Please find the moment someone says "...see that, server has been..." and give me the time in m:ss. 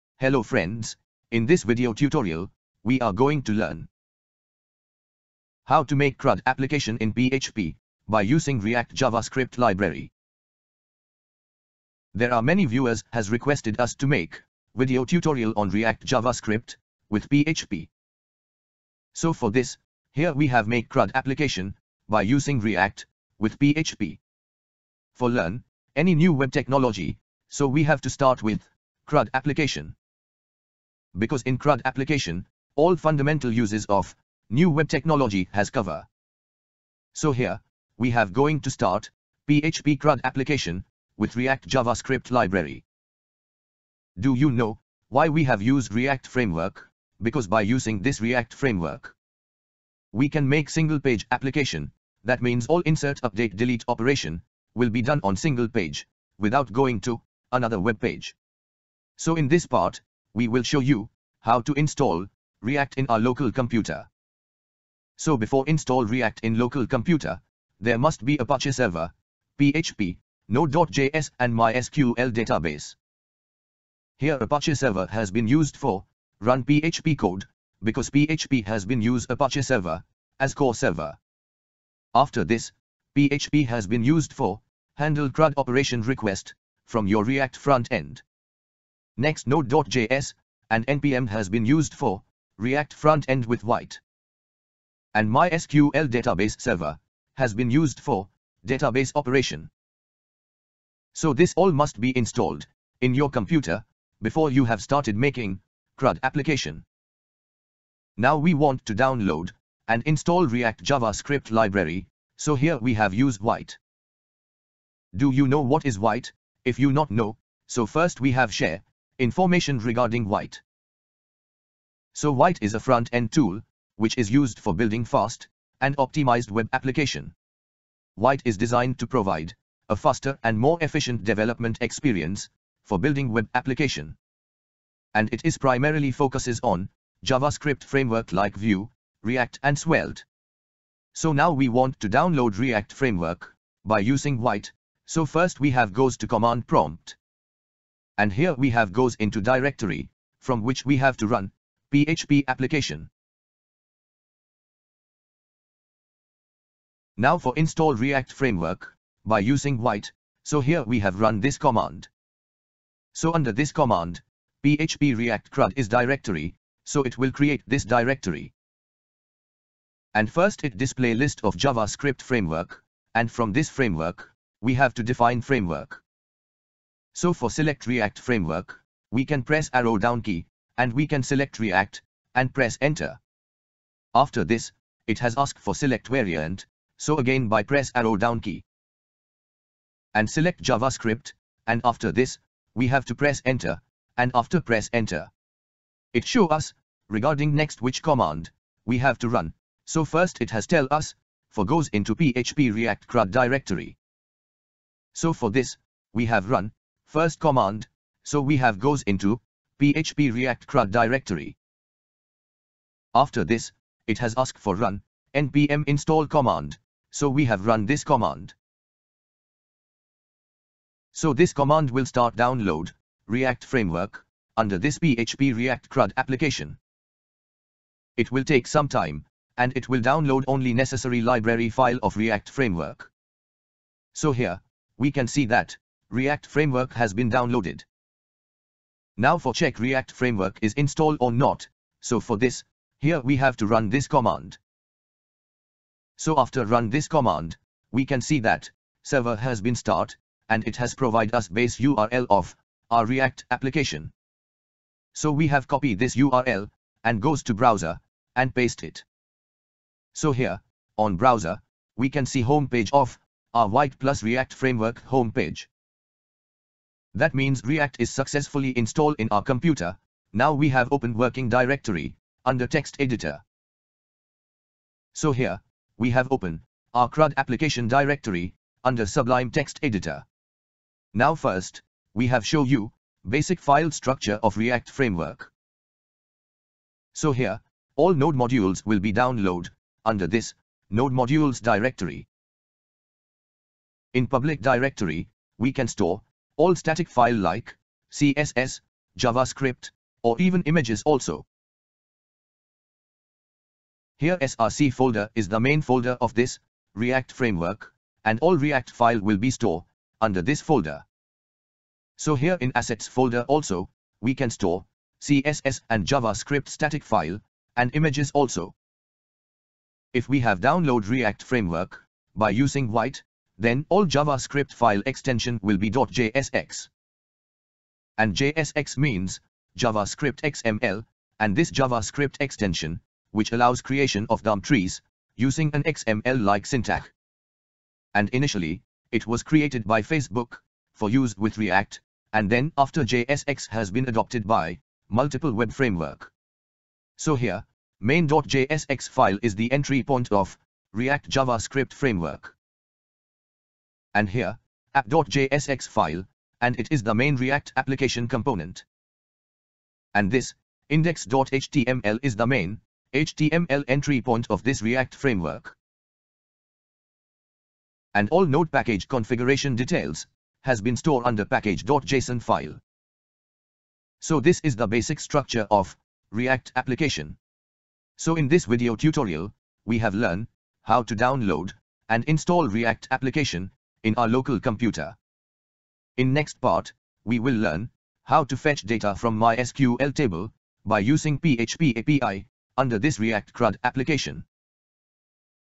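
4:08.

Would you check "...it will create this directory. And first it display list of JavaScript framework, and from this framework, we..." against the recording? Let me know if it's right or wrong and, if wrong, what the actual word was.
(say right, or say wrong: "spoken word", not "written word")
right.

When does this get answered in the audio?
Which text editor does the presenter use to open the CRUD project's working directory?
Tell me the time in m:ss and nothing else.
4:39.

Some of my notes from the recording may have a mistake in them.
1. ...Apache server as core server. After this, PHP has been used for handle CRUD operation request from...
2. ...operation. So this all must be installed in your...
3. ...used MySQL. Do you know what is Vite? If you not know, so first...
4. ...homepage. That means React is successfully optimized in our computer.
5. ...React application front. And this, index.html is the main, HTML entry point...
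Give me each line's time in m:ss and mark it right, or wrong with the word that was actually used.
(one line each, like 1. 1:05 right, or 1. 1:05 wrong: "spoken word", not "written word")
1. 1:19 right
2. 1:39 right
3. 1:53 wrong: "Vite", not "MySQL"
4. 4:25 wrong: "installed", not "optimized"
5. 5:57 wrong: "component", not "front".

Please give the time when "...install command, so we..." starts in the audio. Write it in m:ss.
3:35.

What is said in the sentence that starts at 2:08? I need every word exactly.
Vite is designed to provide a faster and more efficient development experience for building web application.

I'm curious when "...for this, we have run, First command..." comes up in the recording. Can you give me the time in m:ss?
3:25.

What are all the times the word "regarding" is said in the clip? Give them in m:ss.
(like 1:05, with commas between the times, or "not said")
1:59, 3:17.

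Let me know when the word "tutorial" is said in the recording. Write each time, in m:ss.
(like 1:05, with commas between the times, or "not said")
0:01, 0:15, 6:18.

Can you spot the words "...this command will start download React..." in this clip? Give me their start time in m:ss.
3:41.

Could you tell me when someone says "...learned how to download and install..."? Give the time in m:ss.
6:20.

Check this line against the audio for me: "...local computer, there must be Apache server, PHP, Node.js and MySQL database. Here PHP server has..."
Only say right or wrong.
wrong.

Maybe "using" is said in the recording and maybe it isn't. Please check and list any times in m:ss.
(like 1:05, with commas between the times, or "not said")
0:08, 0:22, 0:47, 2:23, 2:39, 5:22, 5:35, 6:30.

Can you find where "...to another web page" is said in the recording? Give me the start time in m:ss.
0:57.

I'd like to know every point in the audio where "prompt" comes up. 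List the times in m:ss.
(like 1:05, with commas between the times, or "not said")
2:26.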